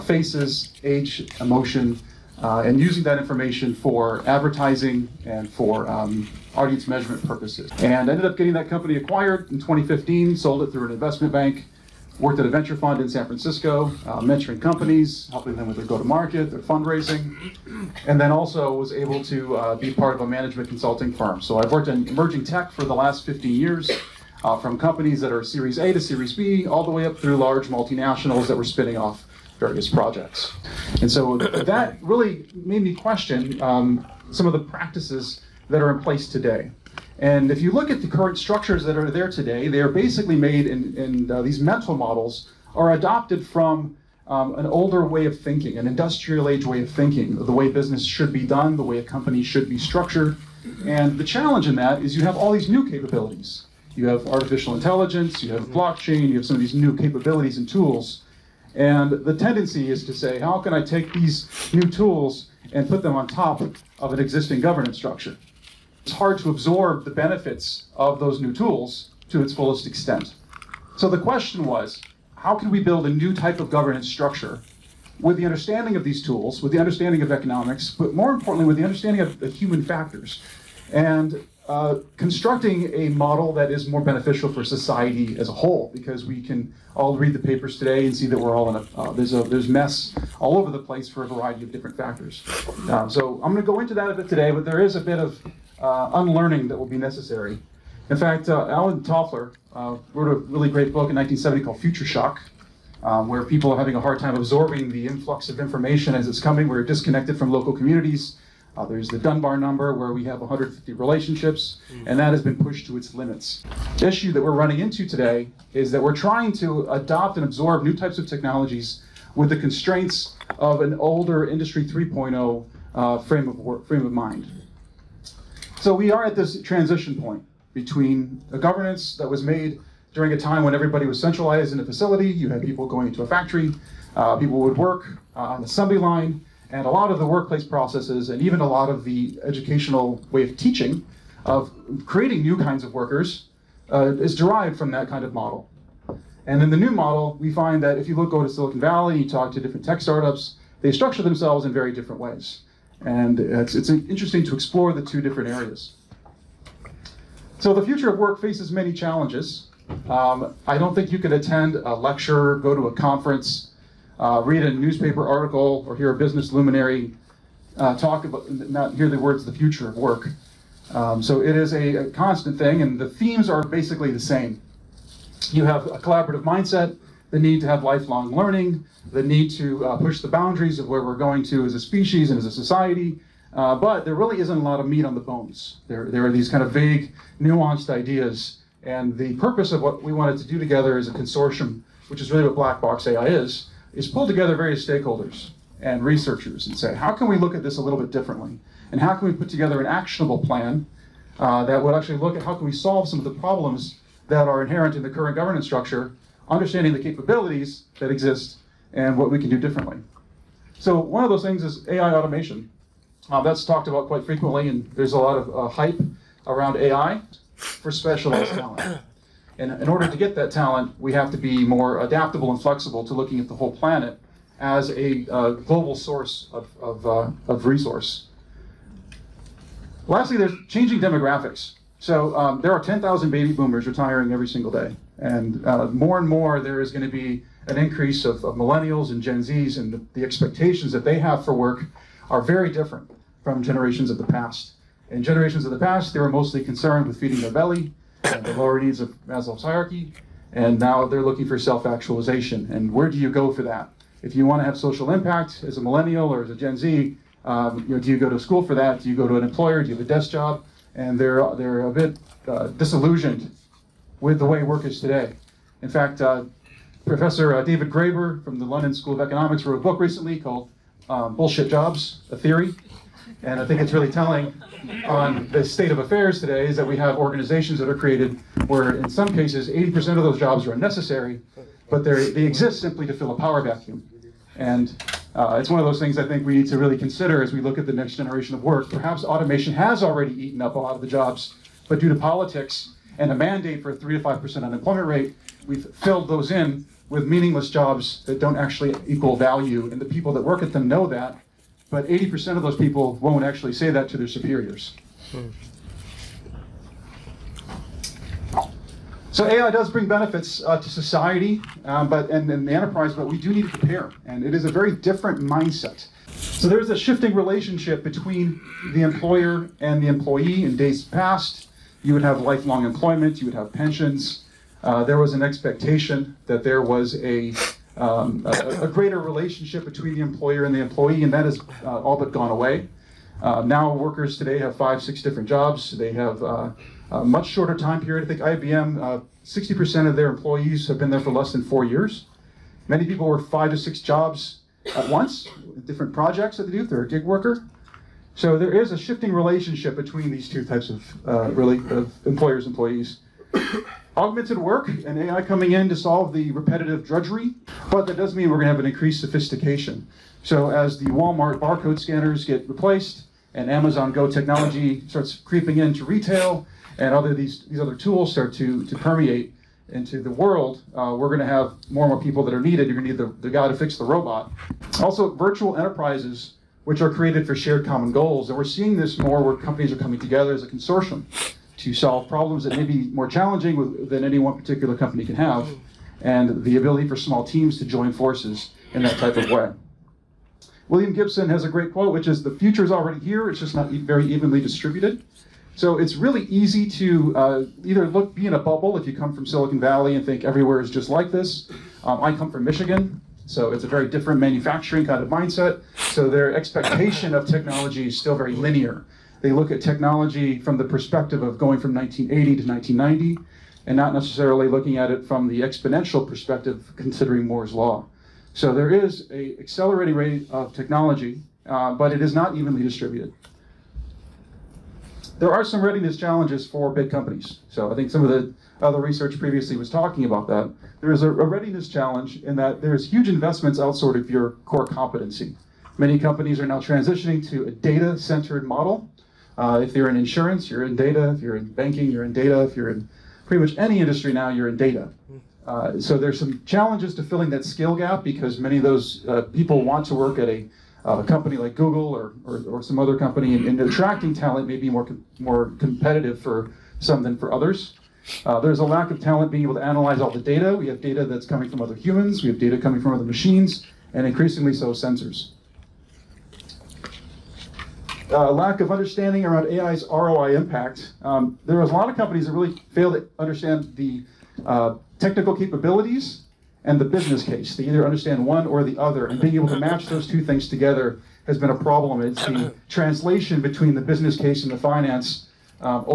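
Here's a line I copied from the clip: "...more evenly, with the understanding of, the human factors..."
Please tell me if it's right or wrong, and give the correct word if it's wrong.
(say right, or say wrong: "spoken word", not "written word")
wrong: "importantly", not "evenly".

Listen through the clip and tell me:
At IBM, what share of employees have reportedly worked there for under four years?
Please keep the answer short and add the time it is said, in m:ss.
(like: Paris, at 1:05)
60%, at 5:39.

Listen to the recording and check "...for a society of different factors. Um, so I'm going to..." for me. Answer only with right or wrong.
wrong.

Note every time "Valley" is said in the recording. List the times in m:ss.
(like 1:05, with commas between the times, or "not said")
2:28, 6:39.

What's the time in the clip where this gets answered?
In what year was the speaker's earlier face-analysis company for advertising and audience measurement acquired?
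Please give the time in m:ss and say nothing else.
0:09.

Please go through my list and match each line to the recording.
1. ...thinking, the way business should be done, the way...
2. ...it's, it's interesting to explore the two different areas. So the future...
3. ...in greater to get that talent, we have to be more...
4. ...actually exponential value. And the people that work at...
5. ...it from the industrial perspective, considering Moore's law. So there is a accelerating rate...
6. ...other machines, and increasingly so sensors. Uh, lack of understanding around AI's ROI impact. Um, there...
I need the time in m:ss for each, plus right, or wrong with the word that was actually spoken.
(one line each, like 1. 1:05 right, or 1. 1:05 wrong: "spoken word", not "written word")
1. 0:46 right
2. 2:33 right
3. 3:39 wrong: "order", not "greater"
4. 4:58 wrong: "equal", not "exponential"
5. 6:55 wrong: "exponential", not "industrial"
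6. 7:43 right.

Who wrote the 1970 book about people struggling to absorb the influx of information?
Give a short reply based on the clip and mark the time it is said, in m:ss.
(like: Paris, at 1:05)
Alan Toffler, at 1:38.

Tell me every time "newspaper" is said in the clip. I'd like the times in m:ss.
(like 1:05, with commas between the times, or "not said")
2:44.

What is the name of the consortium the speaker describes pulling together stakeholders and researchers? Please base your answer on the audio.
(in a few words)
Blackbox AI.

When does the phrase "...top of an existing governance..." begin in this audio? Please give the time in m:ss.
1:03.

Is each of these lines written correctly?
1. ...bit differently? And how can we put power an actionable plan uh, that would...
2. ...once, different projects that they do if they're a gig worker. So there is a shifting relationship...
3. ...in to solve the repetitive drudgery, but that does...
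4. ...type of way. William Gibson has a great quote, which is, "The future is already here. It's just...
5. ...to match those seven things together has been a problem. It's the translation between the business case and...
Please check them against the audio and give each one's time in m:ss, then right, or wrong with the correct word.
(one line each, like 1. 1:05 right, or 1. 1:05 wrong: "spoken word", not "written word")
1. 3:17 wrong: "together", not "power"
2. 5:45 right
3. 5:55 right
4. 6:29 right
5. 7:59 wrong: "two", not "seven".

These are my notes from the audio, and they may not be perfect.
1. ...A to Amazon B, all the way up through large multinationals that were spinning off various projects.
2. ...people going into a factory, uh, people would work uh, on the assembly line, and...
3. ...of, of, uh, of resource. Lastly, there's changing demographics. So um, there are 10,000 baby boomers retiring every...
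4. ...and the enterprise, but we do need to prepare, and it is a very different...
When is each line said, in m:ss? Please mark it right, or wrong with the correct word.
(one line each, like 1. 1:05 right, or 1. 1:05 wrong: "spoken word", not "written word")
1. 0:25 wrong: "Series", not "Amazon"
2. 2:12 right
3. 3:46 right
4. 5:12 right.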